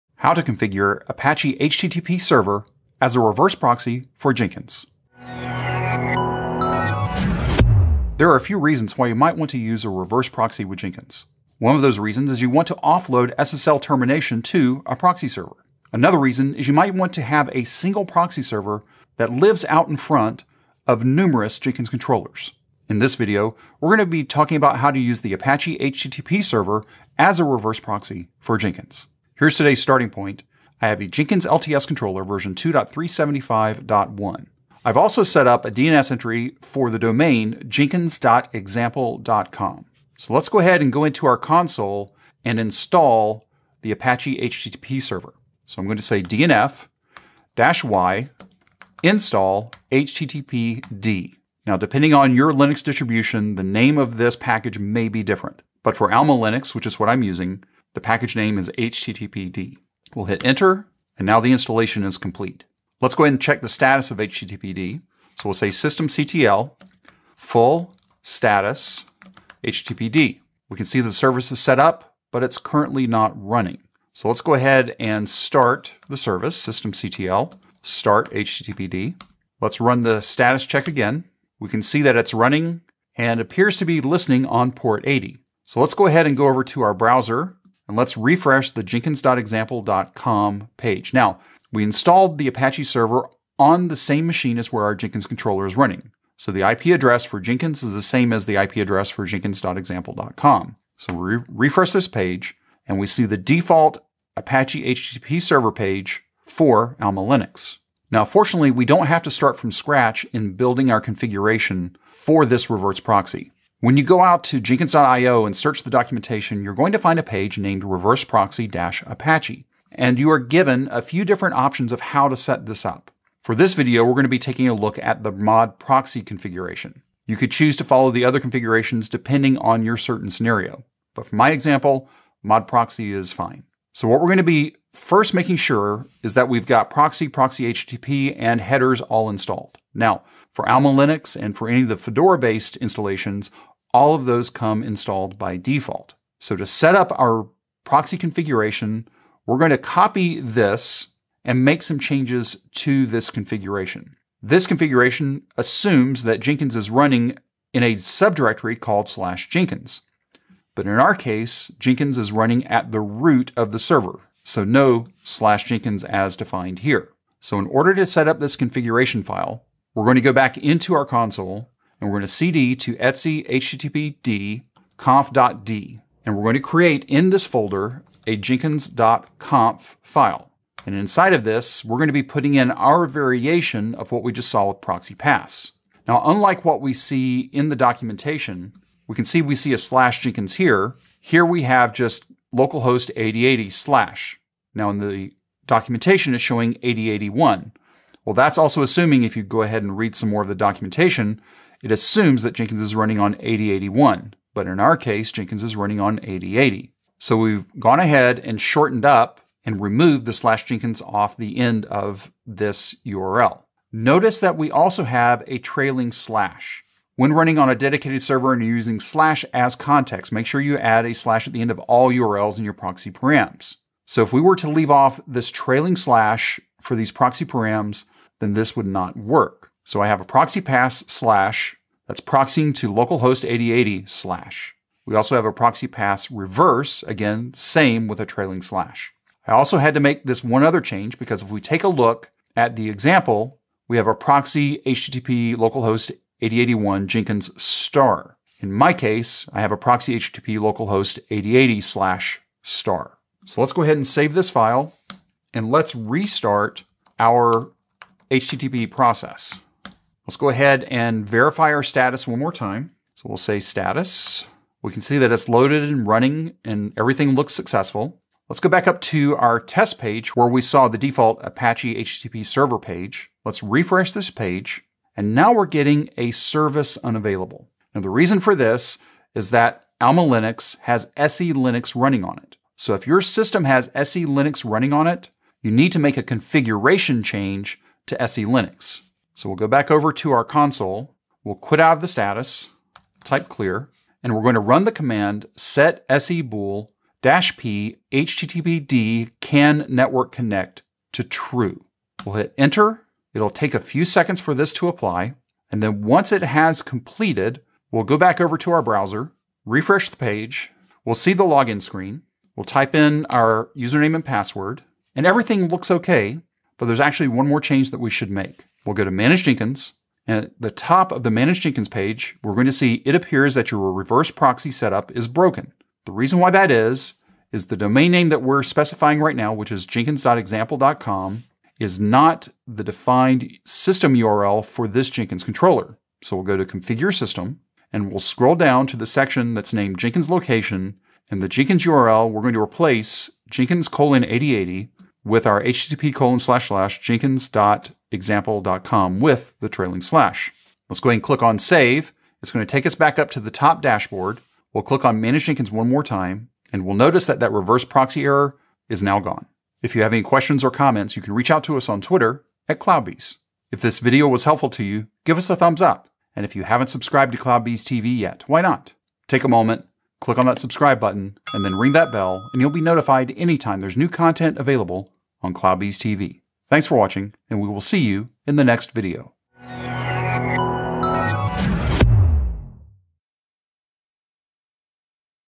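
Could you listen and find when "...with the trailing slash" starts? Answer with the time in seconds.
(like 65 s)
349 s.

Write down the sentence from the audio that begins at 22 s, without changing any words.
In this video, we're going to be talking about how to use the Apache HTTP server as a reverse proxy for Jenkins.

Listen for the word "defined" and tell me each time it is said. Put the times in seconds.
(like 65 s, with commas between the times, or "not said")
166 s, 332 s.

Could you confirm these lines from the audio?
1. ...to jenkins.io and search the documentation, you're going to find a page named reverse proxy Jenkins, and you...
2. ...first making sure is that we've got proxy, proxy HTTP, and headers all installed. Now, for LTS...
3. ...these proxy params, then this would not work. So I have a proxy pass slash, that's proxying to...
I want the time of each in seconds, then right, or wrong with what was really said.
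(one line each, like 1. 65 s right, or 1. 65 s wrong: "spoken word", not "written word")
1. 114 s wrong: "Apache", not "Jenkins"
2. 134 s wrong: "Alma", not "LTS"
3. 226 s right.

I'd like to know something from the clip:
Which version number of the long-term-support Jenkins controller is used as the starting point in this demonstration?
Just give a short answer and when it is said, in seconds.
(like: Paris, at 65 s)
2.375.1, at 32 s.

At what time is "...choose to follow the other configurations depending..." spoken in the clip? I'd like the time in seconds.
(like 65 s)
127 s.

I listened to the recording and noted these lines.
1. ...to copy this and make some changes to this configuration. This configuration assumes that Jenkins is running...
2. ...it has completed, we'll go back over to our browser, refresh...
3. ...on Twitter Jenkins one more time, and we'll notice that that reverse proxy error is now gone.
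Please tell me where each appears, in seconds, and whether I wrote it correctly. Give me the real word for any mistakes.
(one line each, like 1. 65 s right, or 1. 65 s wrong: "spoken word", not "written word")
1. 149 s right
2. 306 s right
3. 355 s wrong: "Manage", not "Twitter".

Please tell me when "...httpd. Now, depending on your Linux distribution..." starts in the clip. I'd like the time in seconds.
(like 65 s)
49 s.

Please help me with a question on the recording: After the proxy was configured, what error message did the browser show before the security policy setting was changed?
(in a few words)
service unavailable.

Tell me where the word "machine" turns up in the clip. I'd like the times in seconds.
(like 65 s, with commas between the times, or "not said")
94 s.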